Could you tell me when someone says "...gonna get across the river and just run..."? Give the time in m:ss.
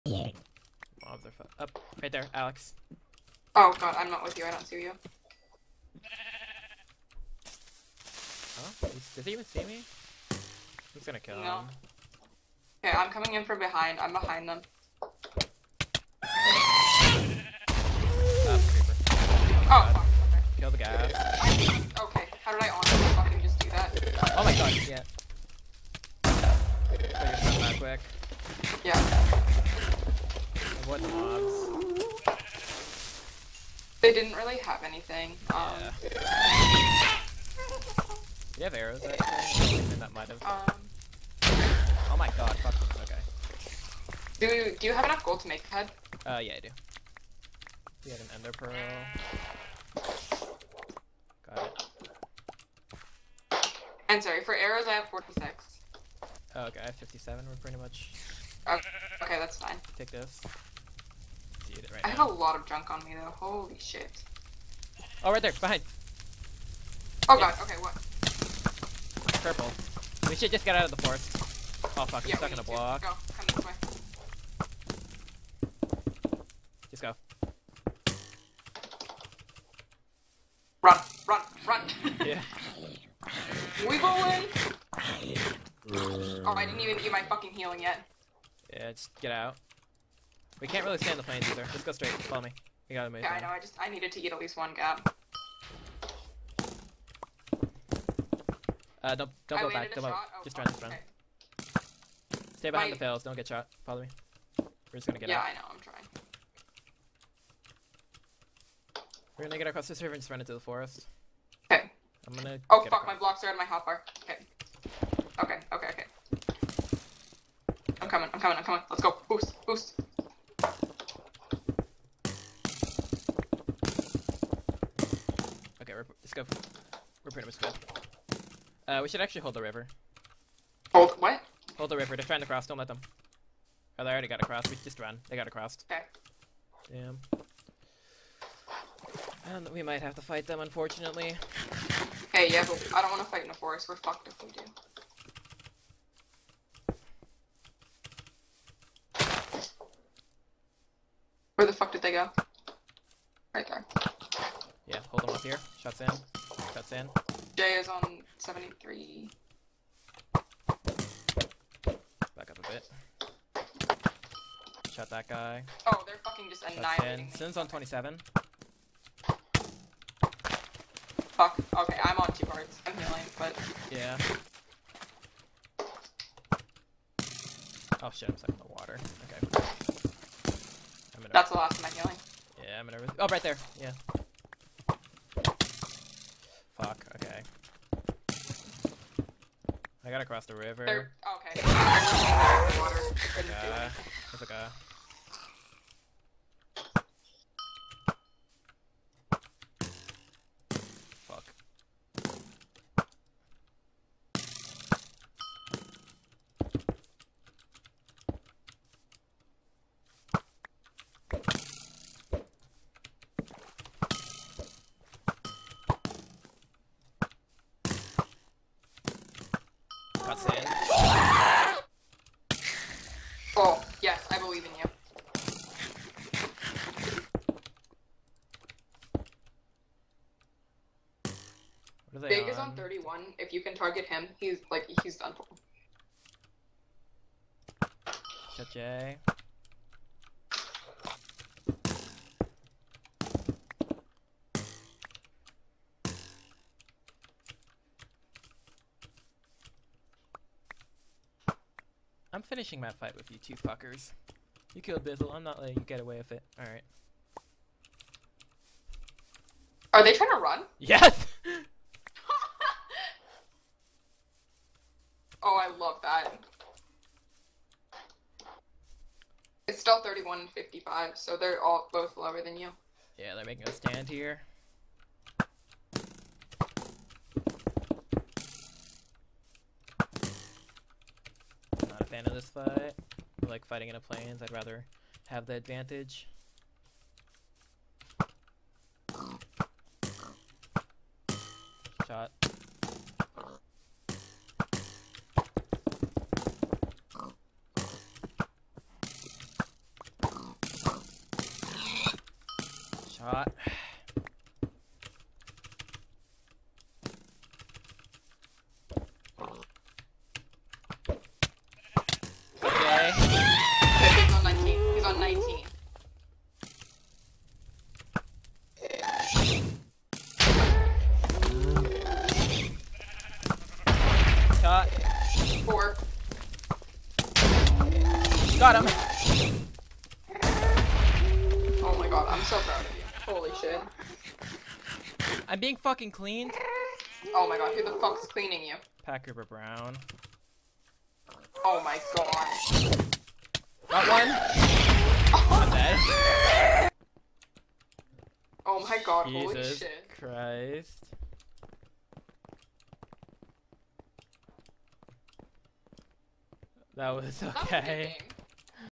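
1:49.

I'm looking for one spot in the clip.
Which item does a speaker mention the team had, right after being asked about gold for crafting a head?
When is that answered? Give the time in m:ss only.
0:48.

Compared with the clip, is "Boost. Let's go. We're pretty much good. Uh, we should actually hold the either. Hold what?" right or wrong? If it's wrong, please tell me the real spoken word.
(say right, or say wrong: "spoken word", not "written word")
wrong: "river", not "either".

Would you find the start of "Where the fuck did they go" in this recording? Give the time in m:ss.
2:31.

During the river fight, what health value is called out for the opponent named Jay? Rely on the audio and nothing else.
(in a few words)
73.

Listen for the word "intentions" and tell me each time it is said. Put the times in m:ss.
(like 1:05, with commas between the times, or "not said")
not said.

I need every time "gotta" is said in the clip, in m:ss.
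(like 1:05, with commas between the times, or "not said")
1:32, 3:10.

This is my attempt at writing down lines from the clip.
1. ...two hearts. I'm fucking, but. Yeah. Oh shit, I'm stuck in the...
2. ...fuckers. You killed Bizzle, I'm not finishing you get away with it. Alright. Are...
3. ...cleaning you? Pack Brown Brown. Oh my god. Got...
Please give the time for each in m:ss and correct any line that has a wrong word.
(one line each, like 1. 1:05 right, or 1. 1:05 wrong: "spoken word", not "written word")
1. 2:52 wrong: "healing", not "fucking"
2. 4:13 wrong: "letting", not "finishing"
3. 5:38 wrong: "River", not "Brown".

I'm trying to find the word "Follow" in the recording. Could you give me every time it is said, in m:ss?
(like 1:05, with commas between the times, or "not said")
1:32, 1:43.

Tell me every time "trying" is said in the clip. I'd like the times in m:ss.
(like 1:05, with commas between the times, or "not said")
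1:45, 2:12, 4:20.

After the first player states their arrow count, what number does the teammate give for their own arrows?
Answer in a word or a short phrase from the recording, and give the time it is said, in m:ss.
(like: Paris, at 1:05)
57, at 0:56.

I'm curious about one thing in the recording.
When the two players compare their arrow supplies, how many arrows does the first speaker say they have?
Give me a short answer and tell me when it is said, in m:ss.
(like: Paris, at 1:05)
46, at 0:54.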